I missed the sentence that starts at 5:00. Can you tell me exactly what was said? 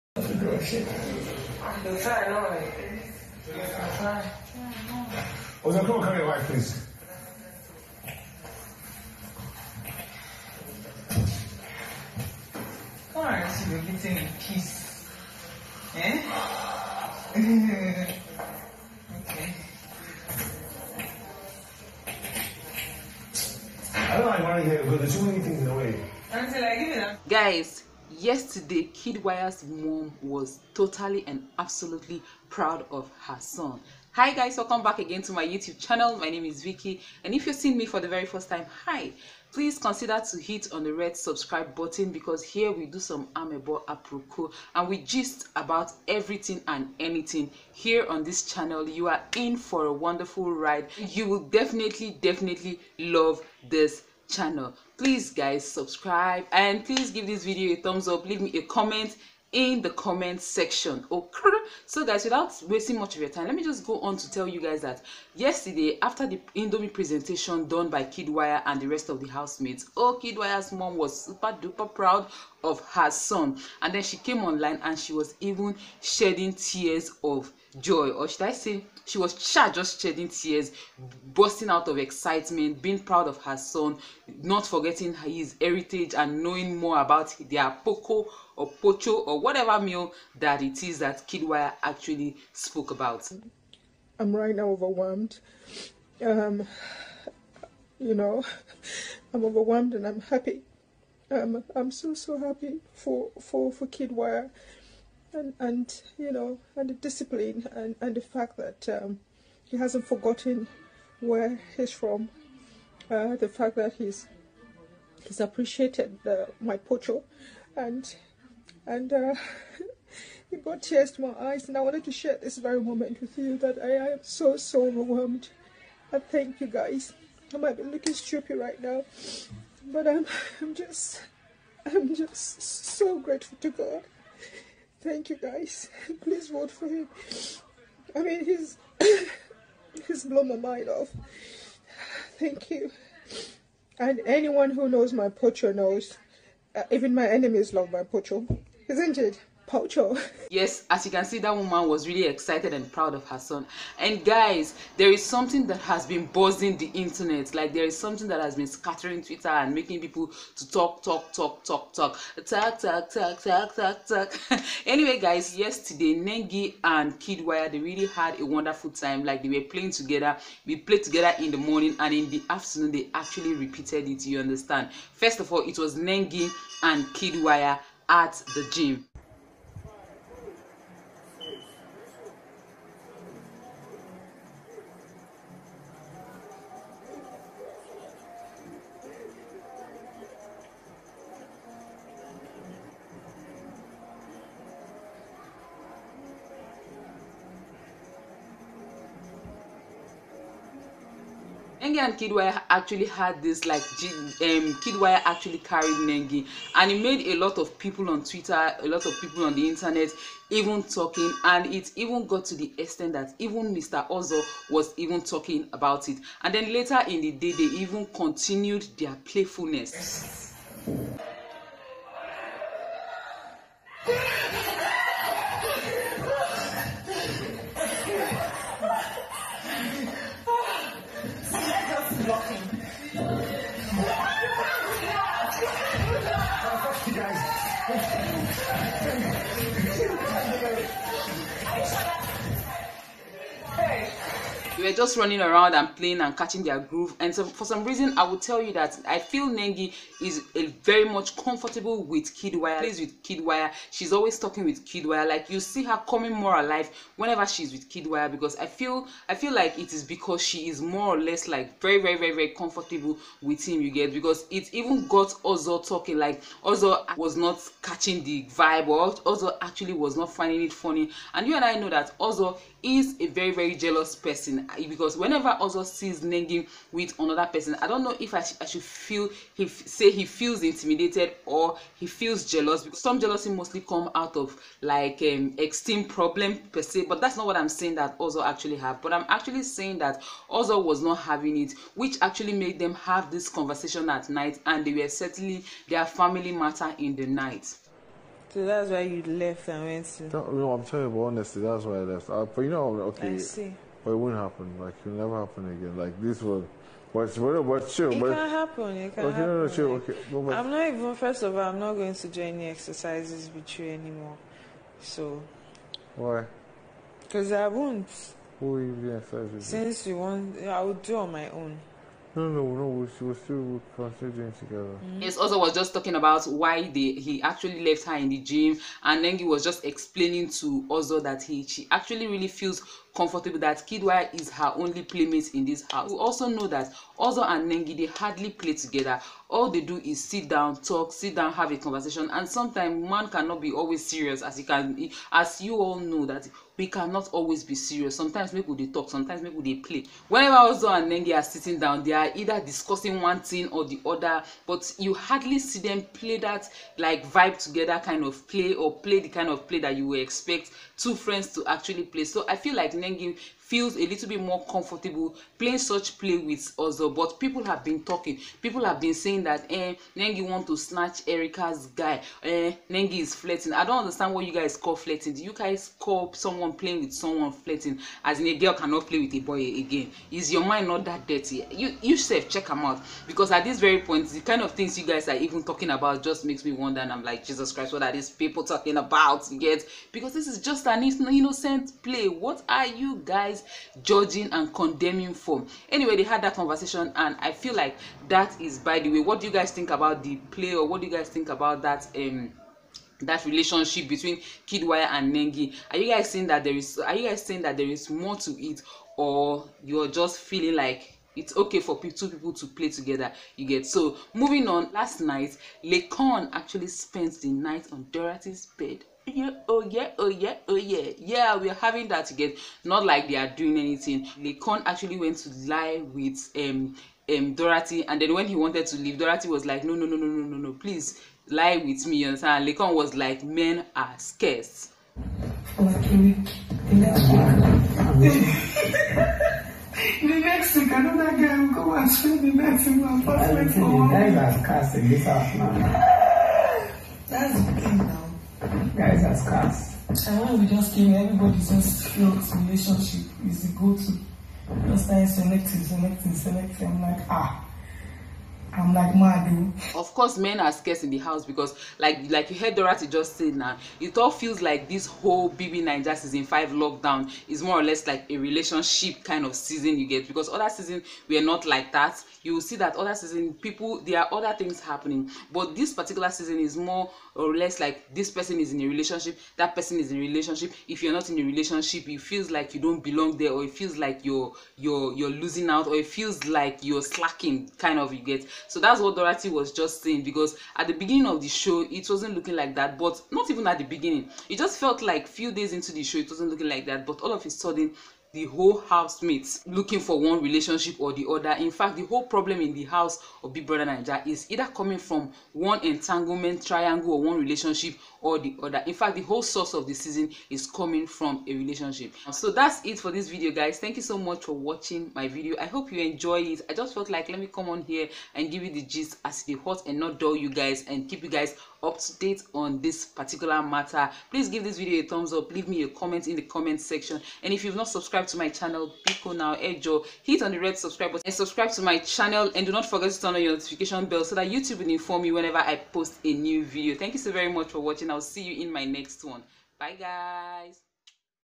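No, no I'm telling you, but honestly, that's why I left.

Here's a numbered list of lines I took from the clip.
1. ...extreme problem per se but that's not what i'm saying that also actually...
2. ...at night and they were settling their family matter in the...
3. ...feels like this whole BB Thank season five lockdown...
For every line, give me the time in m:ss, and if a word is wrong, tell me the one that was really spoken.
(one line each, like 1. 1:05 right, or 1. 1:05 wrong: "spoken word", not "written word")
1. 4:45 right
2. 4:54 right
3. 7:44 wrong: "Niger", not "Thank".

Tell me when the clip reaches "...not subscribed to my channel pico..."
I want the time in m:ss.
8:47.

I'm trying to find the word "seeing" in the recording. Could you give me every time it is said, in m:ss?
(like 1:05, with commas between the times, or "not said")
0:37.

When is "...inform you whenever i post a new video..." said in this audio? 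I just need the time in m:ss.
8:54.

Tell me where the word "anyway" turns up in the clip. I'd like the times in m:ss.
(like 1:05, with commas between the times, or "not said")
2:44, 6:35.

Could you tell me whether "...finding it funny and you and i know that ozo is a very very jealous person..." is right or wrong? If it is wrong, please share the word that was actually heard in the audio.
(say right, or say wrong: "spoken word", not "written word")
right.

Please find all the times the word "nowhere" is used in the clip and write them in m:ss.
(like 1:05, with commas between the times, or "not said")
not said.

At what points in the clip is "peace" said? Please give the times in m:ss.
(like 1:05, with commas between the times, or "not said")
0:14.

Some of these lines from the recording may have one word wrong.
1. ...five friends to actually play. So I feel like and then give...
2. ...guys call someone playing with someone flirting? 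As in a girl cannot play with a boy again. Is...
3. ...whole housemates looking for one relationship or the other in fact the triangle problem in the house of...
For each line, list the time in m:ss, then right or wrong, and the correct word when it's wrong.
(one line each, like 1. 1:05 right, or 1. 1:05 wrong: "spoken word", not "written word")
1. 6:00 wrong: "two", not "five"
2. 6:15 right
3. 8:18 wrong: "whole", not "triangle".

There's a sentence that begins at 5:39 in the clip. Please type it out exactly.
All they do is sit down, talk, sit down, have a conversation.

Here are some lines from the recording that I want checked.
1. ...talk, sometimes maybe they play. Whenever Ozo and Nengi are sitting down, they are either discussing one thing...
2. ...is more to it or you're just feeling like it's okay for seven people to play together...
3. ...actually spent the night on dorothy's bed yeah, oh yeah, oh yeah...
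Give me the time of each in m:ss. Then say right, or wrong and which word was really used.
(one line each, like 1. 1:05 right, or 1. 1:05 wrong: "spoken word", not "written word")
1. 5:48 right
2. 6:47 wrong: "two", not "seven"
3. 6:56 right.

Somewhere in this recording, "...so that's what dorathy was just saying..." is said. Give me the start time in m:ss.
8:08.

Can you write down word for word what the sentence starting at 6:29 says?
Yet because this is just an innocent play.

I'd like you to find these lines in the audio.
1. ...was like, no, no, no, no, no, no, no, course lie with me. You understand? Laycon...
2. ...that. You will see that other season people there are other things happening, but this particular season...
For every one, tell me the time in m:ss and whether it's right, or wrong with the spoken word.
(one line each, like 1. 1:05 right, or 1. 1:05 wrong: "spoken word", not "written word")
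1. 7:09 wrong: "please", not "course"
2. 7:51 right.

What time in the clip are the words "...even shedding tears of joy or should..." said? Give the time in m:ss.
1:15.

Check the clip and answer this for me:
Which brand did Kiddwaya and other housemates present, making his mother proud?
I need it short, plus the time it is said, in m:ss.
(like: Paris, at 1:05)
Indomie, at 1:06.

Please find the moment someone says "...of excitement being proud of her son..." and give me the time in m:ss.
1:21.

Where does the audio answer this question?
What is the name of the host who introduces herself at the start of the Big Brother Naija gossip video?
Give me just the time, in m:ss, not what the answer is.
0:36.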